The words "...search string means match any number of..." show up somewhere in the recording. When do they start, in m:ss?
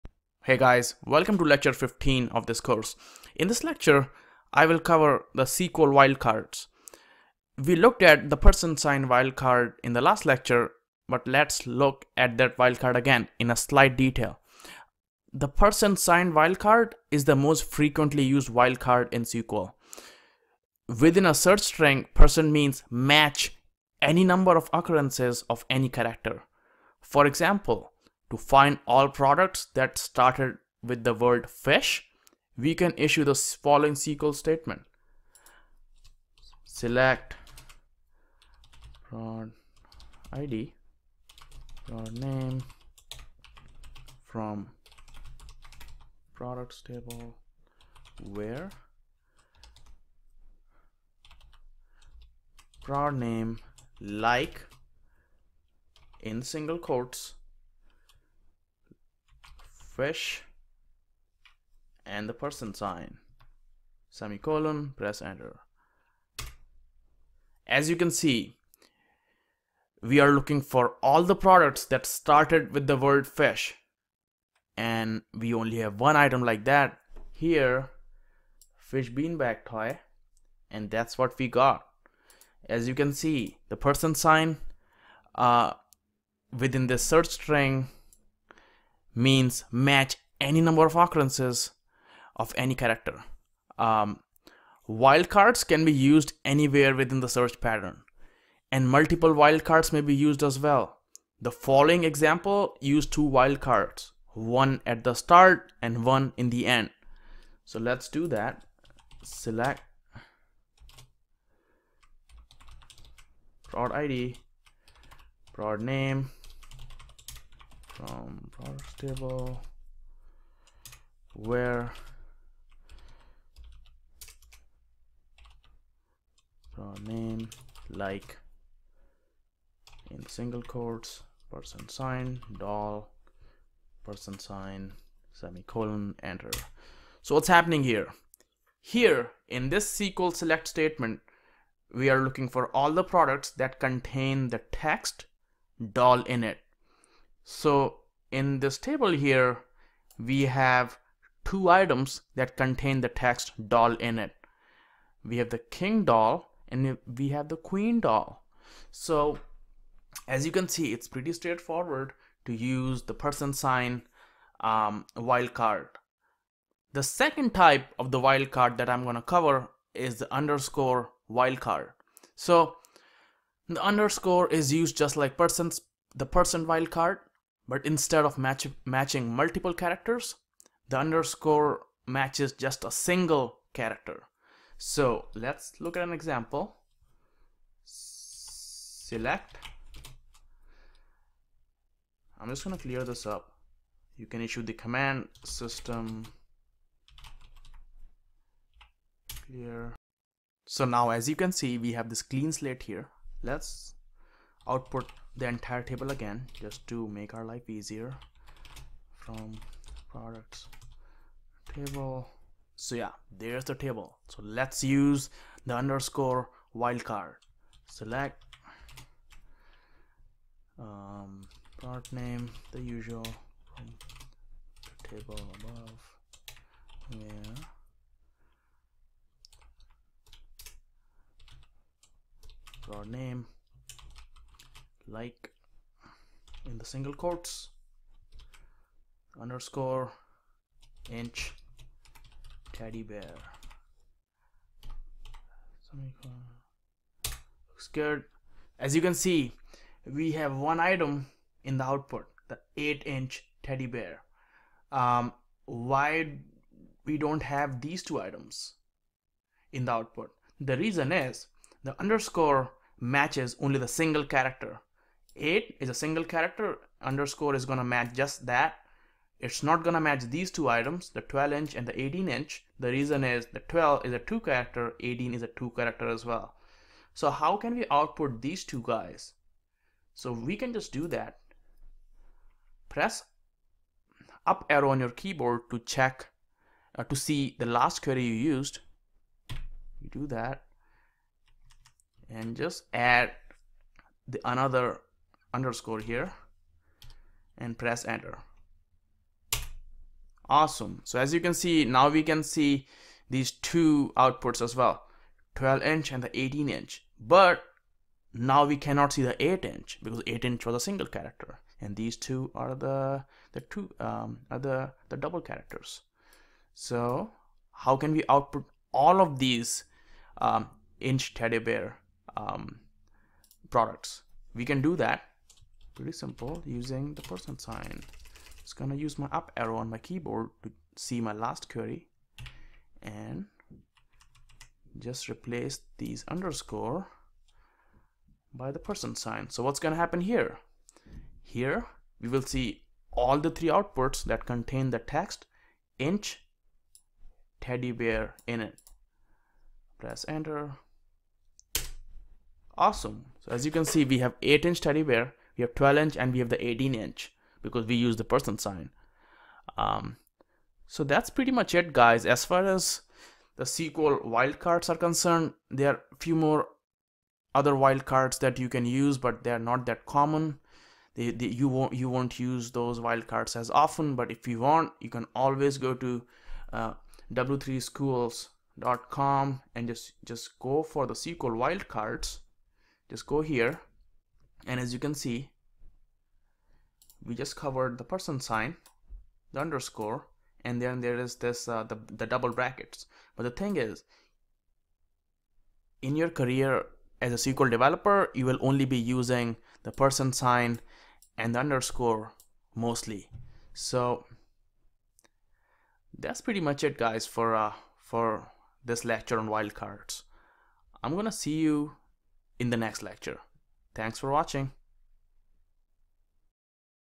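1:26.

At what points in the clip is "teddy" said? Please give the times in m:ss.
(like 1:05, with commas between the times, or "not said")
4:02, 4:13, 5:21, 5:47, 5:54.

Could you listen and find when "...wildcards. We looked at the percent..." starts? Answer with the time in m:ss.
0:05.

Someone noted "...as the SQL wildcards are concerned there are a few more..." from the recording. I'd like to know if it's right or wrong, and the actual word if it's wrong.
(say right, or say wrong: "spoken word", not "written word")
right.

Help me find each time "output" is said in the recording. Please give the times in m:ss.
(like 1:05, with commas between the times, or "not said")
3:24, 4:11, 4:19, 4:37, 5:04, 5:18, 5:43.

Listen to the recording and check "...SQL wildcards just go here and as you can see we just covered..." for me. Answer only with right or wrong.
right.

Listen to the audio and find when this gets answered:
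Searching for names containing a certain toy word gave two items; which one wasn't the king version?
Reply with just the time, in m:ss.
2:37.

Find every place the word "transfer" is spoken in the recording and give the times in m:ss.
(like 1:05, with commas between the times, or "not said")
not said.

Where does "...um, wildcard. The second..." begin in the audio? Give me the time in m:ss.
2:44.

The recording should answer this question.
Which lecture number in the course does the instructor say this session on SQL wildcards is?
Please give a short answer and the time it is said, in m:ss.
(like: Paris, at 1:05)
15, at 0:01.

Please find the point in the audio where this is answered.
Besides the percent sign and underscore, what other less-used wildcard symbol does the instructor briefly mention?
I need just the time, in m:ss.
6:32.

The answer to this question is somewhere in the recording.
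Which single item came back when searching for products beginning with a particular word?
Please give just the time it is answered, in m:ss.
1:18.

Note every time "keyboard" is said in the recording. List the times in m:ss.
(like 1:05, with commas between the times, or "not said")
4:45, 5:29.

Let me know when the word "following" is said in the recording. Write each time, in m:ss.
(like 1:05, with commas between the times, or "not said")
0:33, 1:41.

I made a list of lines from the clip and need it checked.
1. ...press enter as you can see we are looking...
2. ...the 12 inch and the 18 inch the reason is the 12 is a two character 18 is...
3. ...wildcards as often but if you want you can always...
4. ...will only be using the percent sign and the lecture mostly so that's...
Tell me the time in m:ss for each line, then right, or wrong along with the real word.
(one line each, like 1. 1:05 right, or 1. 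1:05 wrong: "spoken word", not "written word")
1. 1:05 right
2. 4:31 right
3. 6:12 right
4. 6:38 wrong: "underscore", not "lecture".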